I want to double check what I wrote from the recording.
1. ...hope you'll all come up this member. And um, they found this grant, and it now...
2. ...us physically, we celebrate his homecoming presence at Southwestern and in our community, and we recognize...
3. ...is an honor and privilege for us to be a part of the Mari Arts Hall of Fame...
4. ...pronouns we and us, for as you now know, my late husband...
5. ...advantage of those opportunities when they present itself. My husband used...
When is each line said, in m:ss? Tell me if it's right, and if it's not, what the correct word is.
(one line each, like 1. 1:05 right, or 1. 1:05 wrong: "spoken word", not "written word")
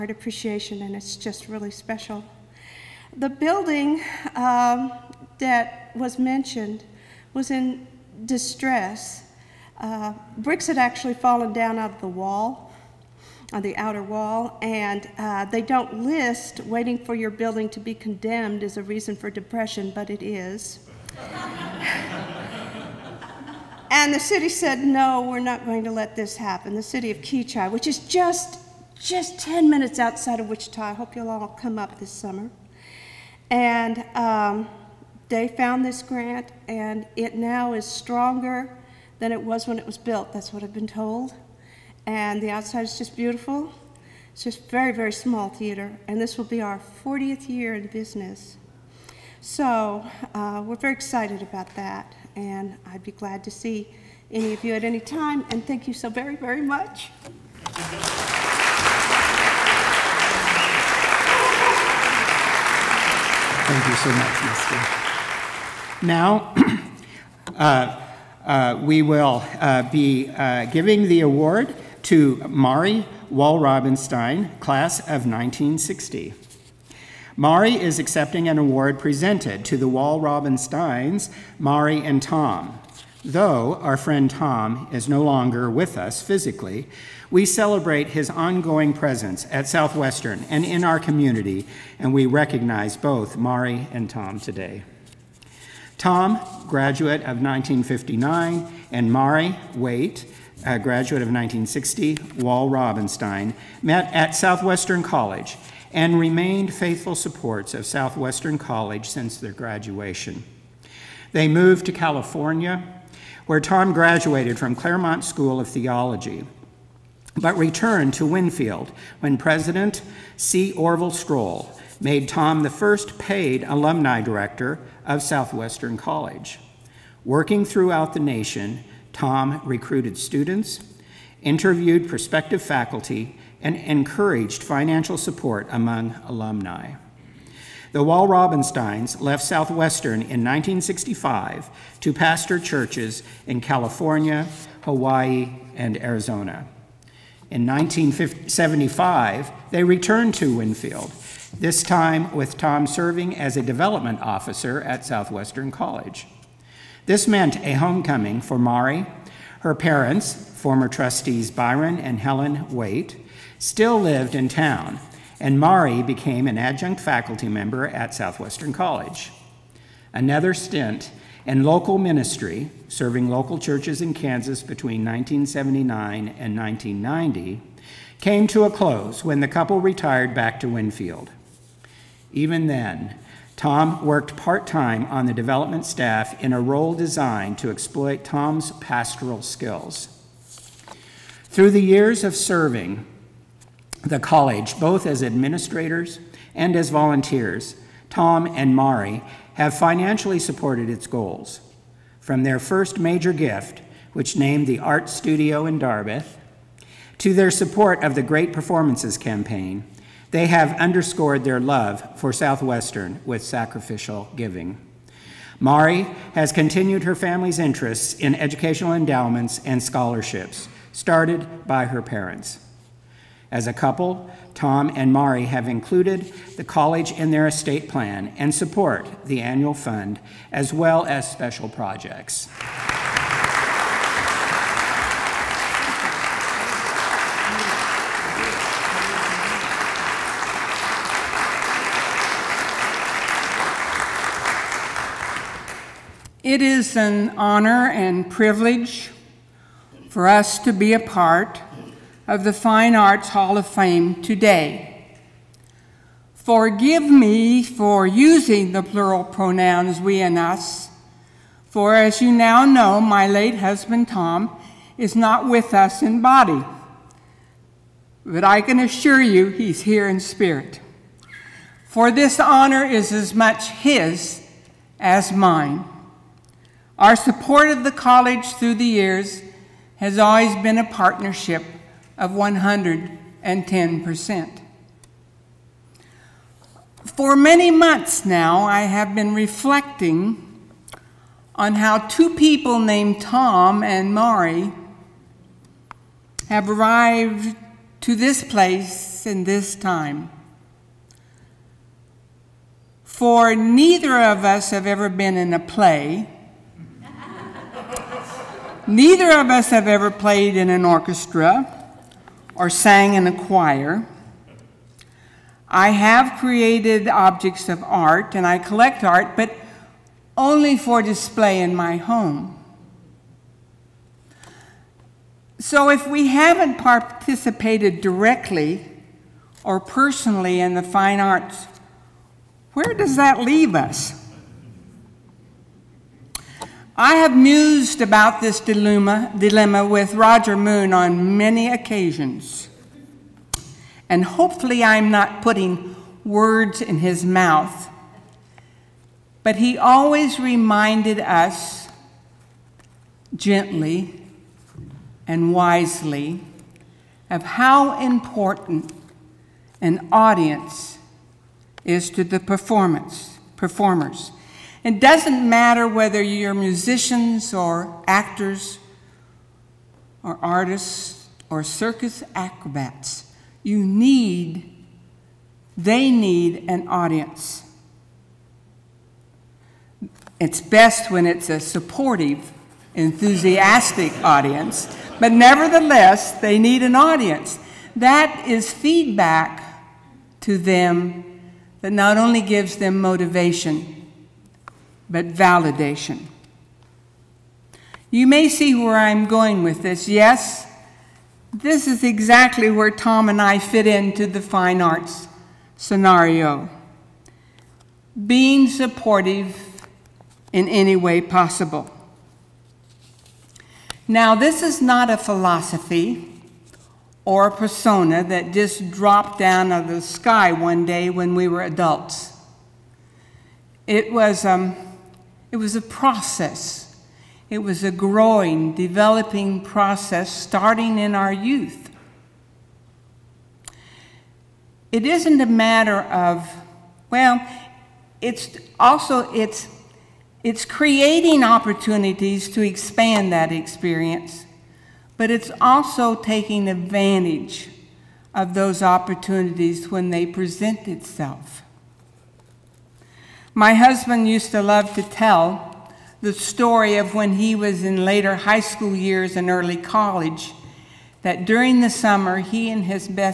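1. 0:30 wrong: "summer", not "member"
2. 1:25 wrong: "ongoing", not "homecoming"
3. 4:06 wrong: "Fine", not "Mari"
4. 4:19 right
5. 7:26 right.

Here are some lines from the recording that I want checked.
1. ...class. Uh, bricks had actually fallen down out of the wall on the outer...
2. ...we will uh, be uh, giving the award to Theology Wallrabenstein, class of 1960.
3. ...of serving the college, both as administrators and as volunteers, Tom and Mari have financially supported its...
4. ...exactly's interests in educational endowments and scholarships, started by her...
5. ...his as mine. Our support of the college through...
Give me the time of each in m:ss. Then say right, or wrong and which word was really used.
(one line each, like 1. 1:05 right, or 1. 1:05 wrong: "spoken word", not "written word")
1. 0:08 wrong: "distress", not "class"
2. 1:08 wrong: "Mari", not "Theology"
3. 3:12 right
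4. 3:37 wrong: "family", not "exactly"
5. 4:33 right.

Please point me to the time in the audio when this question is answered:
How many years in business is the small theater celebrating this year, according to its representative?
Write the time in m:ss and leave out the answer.
0:47.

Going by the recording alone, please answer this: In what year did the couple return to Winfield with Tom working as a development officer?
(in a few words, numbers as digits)
1975.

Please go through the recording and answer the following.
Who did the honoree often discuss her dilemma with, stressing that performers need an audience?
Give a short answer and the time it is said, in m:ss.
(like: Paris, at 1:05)
Roger Moon, at 5:40.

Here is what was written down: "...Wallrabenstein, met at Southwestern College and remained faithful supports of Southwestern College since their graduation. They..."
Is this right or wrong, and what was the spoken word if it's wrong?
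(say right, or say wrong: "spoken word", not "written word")
right.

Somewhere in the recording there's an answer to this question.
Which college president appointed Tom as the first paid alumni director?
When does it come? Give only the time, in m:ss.
2:00.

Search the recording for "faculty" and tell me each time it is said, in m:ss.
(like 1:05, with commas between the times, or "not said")
2:12, 2:46.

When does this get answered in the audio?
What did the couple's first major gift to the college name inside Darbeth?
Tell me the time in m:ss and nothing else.
3:24.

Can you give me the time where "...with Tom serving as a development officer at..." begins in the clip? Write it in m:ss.
2:32.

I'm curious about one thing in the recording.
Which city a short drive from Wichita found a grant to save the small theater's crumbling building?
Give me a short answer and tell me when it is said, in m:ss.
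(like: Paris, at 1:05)
Kechi, at 0:27.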